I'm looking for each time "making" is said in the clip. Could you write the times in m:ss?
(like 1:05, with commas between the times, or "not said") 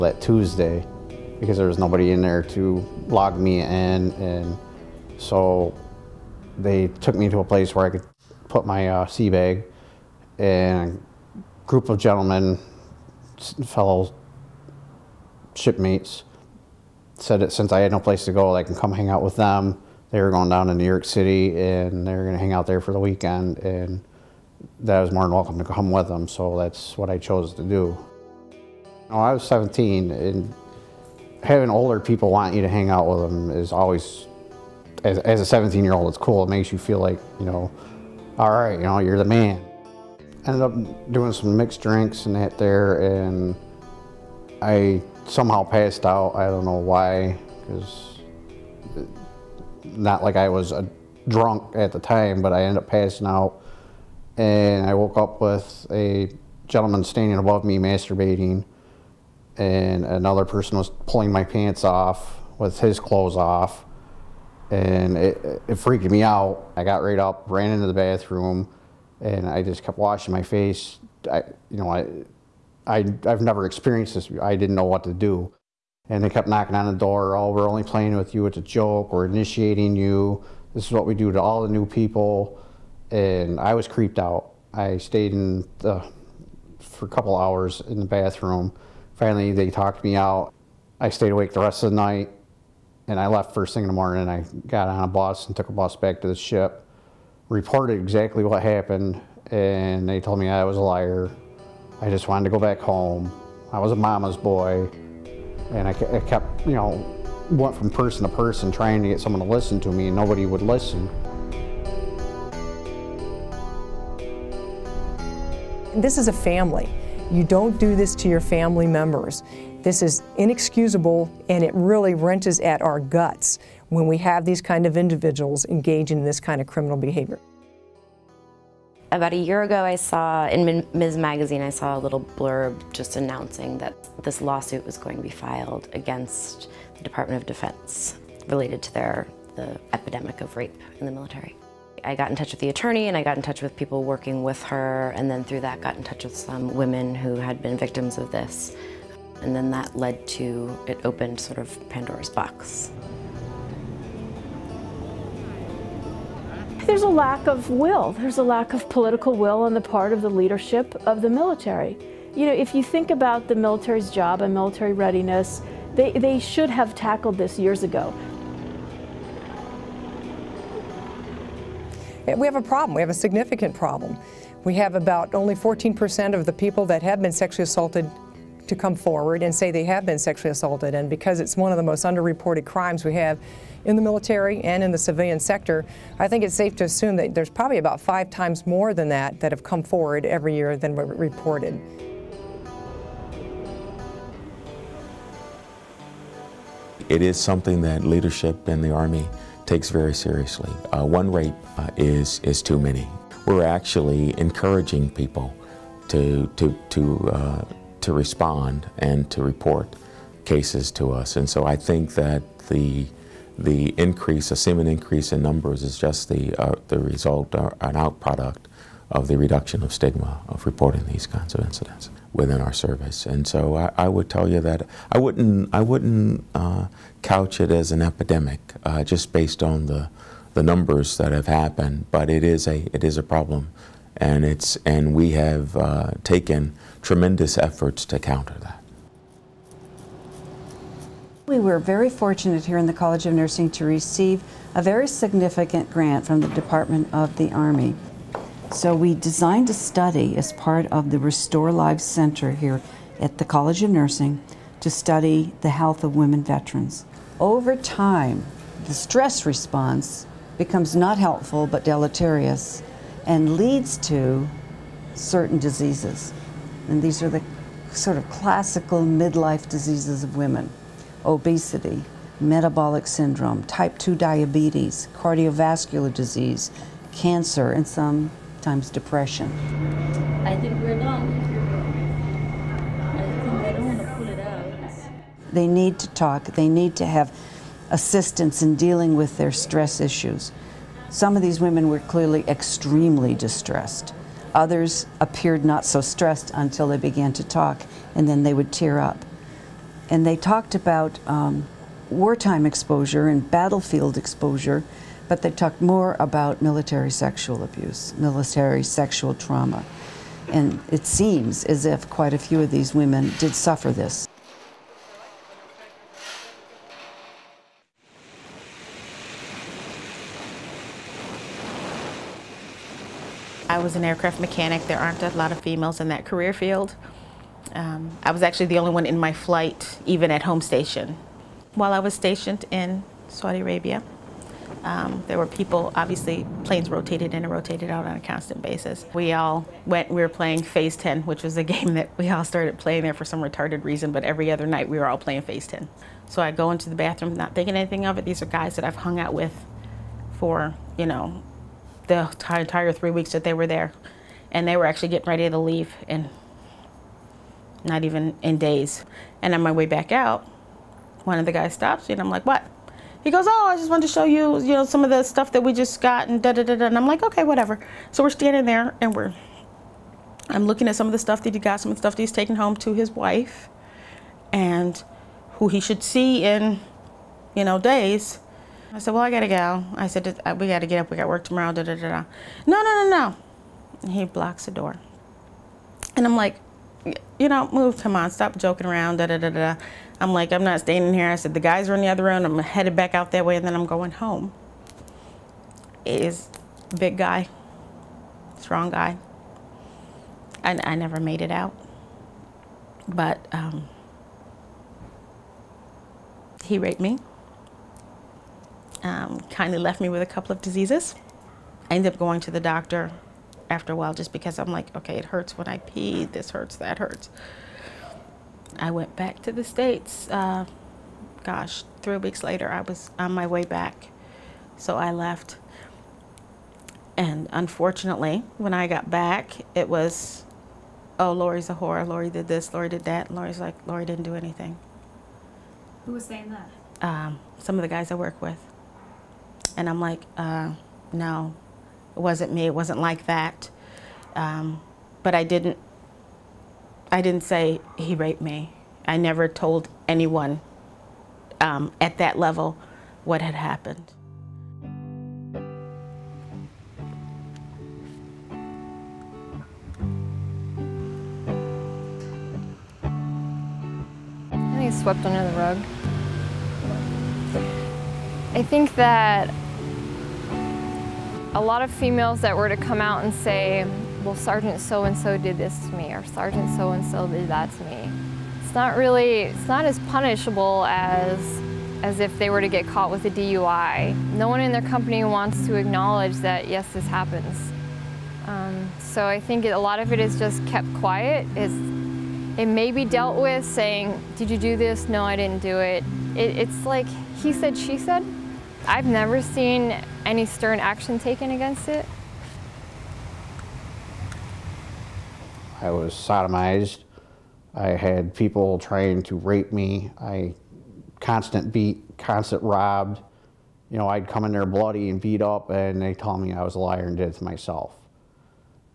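not said.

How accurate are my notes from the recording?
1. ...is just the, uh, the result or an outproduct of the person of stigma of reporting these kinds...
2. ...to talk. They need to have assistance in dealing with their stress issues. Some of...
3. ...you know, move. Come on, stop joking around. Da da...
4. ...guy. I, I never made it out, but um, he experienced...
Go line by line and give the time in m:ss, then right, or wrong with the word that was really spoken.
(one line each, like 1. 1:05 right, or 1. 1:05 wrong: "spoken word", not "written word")
1. 3:35 wrong: "reduction", not "person"
2. 4:45 right
3. 6:27 right
4. 6:38 wrong: "raped", not "experienced".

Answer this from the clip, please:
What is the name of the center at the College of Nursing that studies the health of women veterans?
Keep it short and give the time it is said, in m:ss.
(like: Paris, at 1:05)
Restore Lives Center, at 4:11.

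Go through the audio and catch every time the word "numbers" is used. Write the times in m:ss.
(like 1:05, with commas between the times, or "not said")
3:35, 3:50.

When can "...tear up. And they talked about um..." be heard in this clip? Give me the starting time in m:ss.
4:58.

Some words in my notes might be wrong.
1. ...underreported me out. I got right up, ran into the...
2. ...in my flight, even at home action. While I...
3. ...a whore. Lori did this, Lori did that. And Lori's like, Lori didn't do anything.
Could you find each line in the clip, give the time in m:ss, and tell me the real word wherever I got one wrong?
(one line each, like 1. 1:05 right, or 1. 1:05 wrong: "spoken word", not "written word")
1. 1:05 wrong: "freaked", not "underreported"
2. 5:29 wrong: "station", not "action"
3. 7:11 right.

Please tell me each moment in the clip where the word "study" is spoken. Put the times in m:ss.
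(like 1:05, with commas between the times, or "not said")
4:09, 4:14.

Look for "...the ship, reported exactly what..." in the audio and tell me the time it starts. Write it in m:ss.
1:36.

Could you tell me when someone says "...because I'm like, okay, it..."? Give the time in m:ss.
6:54.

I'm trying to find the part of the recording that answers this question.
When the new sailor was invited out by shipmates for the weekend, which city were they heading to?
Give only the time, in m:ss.
0:20.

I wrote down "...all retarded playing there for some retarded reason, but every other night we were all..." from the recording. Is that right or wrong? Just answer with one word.
wrong.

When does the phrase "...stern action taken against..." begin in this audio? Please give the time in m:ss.
8:20.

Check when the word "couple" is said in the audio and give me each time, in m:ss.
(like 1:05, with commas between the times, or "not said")
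1:27, 6:50.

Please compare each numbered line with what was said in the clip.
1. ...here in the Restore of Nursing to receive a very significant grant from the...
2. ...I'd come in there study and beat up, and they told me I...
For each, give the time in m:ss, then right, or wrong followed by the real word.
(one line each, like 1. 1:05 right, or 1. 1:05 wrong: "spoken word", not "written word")
1. 4:02 wrong: "College", not "Restore"
2. 8:34 wrong: "bloody", not "study".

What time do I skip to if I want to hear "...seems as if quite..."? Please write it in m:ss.
5:11.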